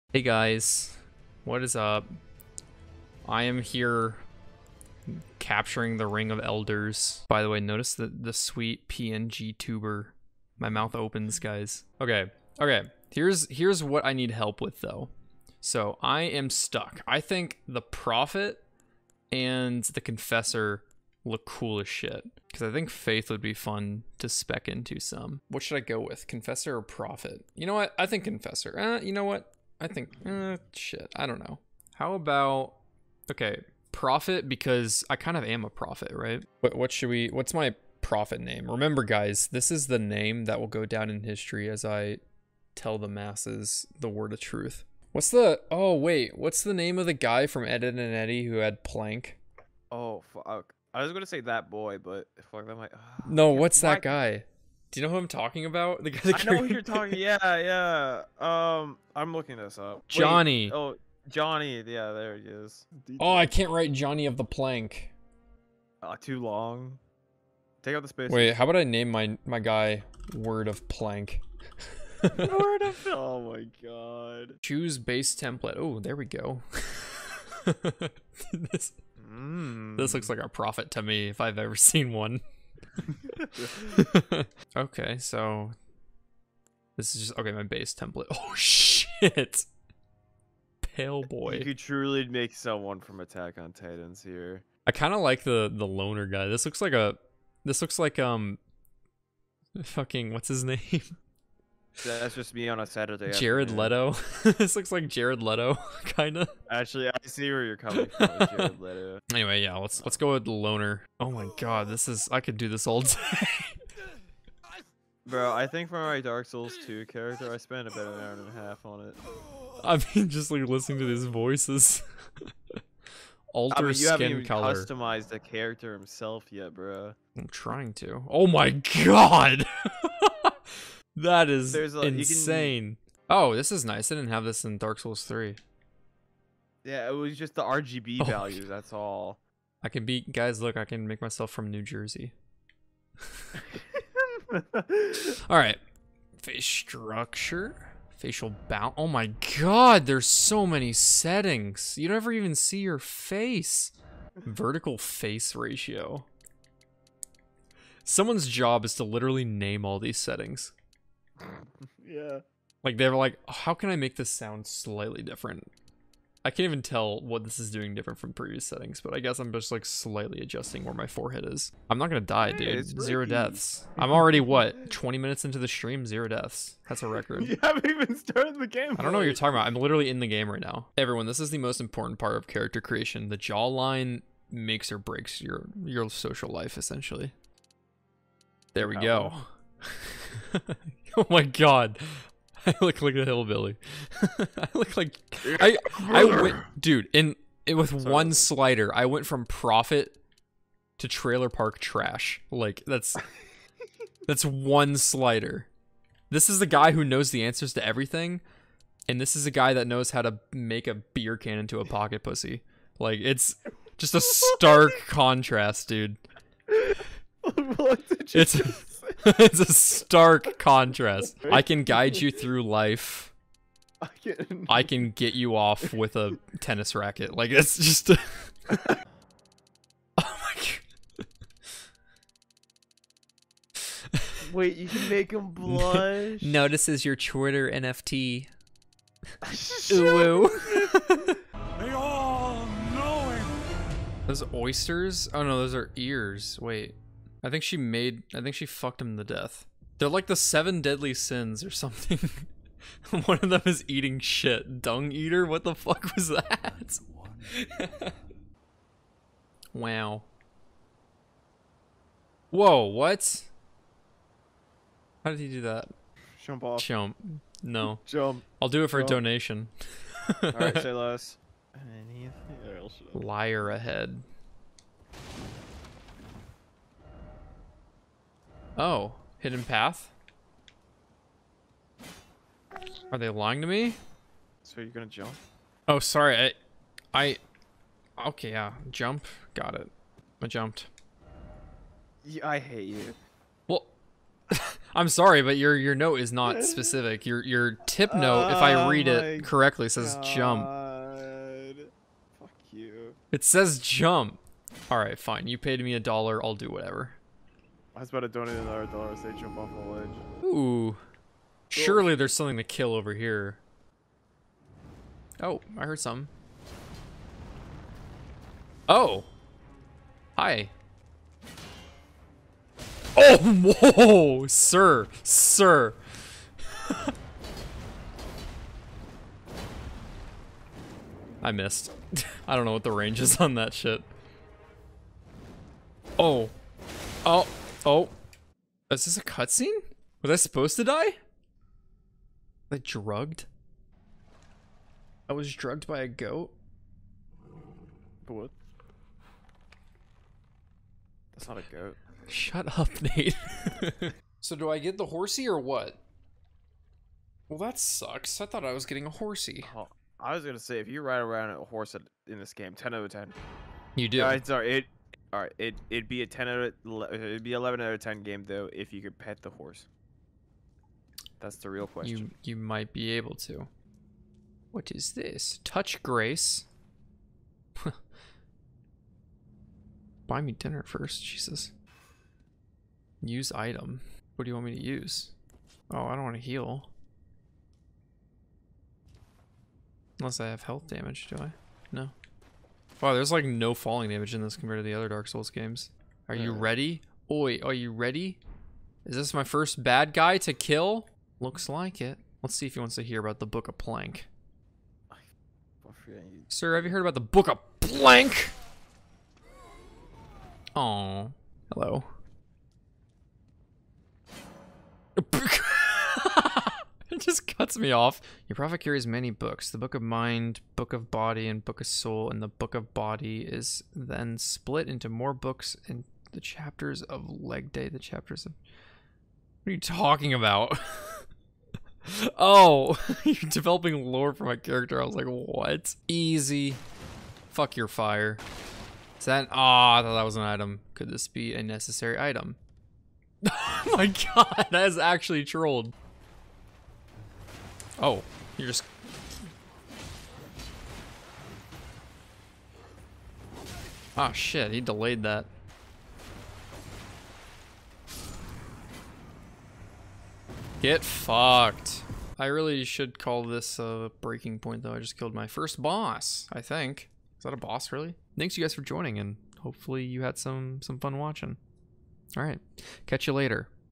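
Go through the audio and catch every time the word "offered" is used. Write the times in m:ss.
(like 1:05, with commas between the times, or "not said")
not said.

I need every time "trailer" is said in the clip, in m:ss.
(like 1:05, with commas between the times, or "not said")
3:21.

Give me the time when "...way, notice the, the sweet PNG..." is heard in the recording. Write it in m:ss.
0:07.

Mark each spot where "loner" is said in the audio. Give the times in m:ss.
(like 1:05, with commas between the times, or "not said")
1:35, 1:50.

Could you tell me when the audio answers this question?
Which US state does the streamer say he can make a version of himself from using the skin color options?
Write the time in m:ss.
2:21.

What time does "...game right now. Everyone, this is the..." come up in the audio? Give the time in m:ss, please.
3:00.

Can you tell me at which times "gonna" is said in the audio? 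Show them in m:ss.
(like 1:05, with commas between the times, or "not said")
0:51, 2:52, 4:44, 6:00.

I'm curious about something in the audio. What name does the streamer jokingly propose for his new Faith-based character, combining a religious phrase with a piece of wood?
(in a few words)
Word of Plank.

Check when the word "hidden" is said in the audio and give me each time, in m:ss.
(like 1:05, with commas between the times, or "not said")
4:39.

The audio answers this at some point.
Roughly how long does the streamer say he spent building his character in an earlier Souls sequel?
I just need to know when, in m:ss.
1:57.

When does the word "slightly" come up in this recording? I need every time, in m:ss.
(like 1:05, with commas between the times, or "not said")
2:44, 2:49.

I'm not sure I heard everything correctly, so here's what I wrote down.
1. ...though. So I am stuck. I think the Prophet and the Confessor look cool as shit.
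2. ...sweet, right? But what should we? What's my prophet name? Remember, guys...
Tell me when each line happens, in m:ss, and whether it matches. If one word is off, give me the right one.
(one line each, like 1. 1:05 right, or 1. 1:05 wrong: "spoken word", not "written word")
1. 0:14 right
2. 0:35 wrong: "prophet", not "sweet".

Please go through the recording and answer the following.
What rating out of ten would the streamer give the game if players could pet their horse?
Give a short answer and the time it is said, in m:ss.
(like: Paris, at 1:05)
11, at 6:07.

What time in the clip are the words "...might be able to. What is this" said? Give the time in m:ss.
6:12.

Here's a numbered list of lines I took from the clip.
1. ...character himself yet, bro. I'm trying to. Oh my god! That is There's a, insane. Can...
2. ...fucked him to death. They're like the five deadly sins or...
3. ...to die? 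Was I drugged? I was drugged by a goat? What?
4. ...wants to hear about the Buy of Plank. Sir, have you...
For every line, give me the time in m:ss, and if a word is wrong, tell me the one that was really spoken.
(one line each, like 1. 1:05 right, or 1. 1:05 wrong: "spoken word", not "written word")
1. 2:05 right
2. 4:08 wrong: "seven", not "five"
3. 5:40 right
4. 6:42 wrong: "Book", not "Buy".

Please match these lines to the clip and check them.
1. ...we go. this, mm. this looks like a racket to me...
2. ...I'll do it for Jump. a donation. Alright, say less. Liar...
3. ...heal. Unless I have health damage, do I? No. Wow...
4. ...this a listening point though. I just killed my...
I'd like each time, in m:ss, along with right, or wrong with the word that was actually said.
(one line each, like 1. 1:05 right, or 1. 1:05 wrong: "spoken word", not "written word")
1. 1:16 wrong: "prophet", not "racket"
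2. 4:28 right
3. 6:26 right
4. 7:43 wrong: "breaking", not "listening".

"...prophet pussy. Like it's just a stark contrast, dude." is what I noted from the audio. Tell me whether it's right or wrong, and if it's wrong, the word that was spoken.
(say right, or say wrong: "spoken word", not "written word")
wrong: "pocket", not "prophet".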